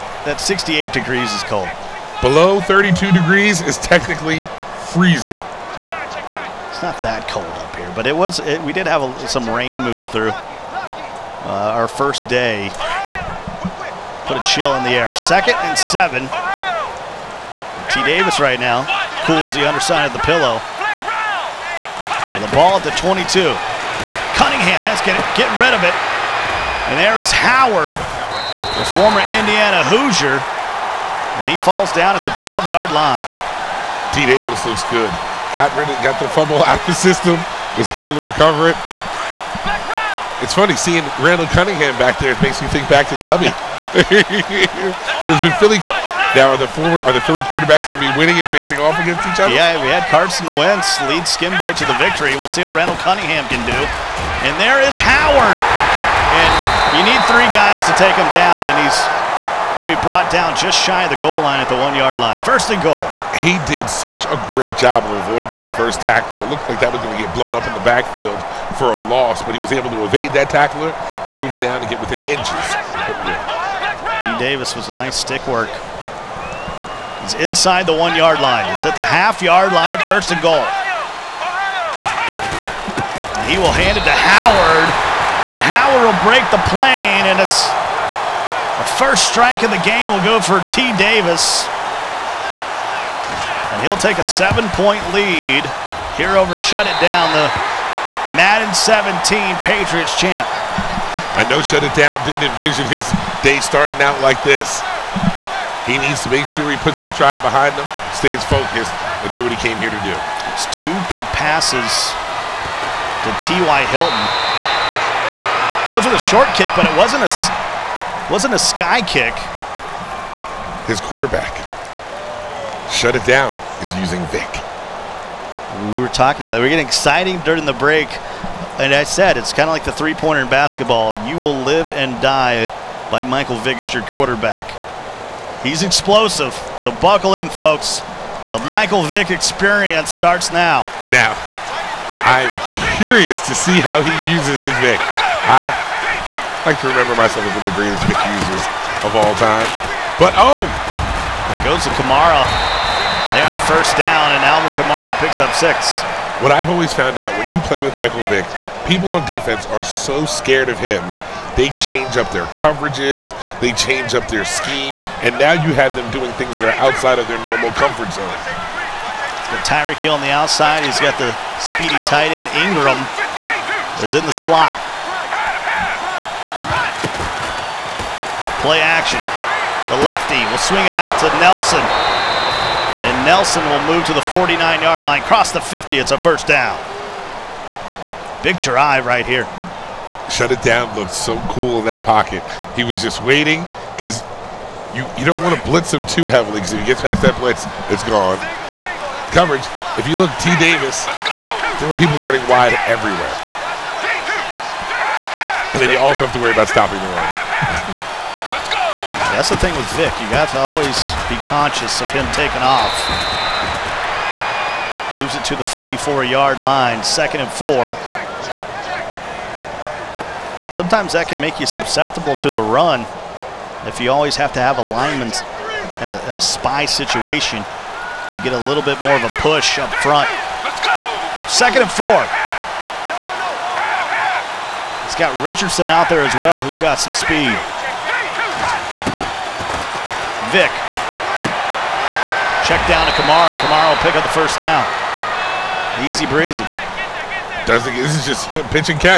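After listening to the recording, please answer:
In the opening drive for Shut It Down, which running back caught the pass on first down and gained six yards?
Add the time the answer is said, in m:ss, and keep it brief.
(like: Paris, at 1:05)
Alvin Kamara, at 2:34.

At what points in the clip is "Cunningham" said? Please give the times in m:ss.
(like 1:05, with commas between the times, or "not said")
0:24, 0:41, 0:53.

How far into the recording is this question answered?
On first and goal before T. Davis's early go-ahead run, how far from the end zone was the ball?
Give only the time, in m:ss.
1:19.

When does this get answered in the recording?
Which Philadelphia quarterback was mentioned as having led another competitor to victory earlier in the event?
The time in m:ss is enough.
0:50.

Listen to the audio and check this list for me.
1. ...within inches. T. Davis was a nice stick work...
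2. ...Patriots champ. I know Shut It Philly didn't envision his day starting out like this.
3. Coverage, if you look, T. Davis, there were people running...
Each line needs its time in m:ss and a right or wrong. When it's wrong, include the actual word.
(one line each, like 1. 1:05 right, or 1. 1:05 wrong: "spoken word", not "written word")
1. 1:12 right
2. 1:39 wrong: "Down", not "Philly"
3. 3:19 right.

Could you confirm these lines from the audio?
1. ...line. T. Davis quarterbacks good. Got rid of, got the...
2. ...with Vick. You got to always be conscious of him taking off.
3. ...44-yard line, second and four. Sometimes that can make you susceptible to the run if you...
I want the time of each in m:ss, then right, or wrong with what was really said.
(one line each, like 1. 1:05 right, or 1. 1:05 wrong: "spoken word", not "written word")
1. 0:32 wrong: "looks", not "quarterbacks"
2. 3:29 right
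3. 3:35 right.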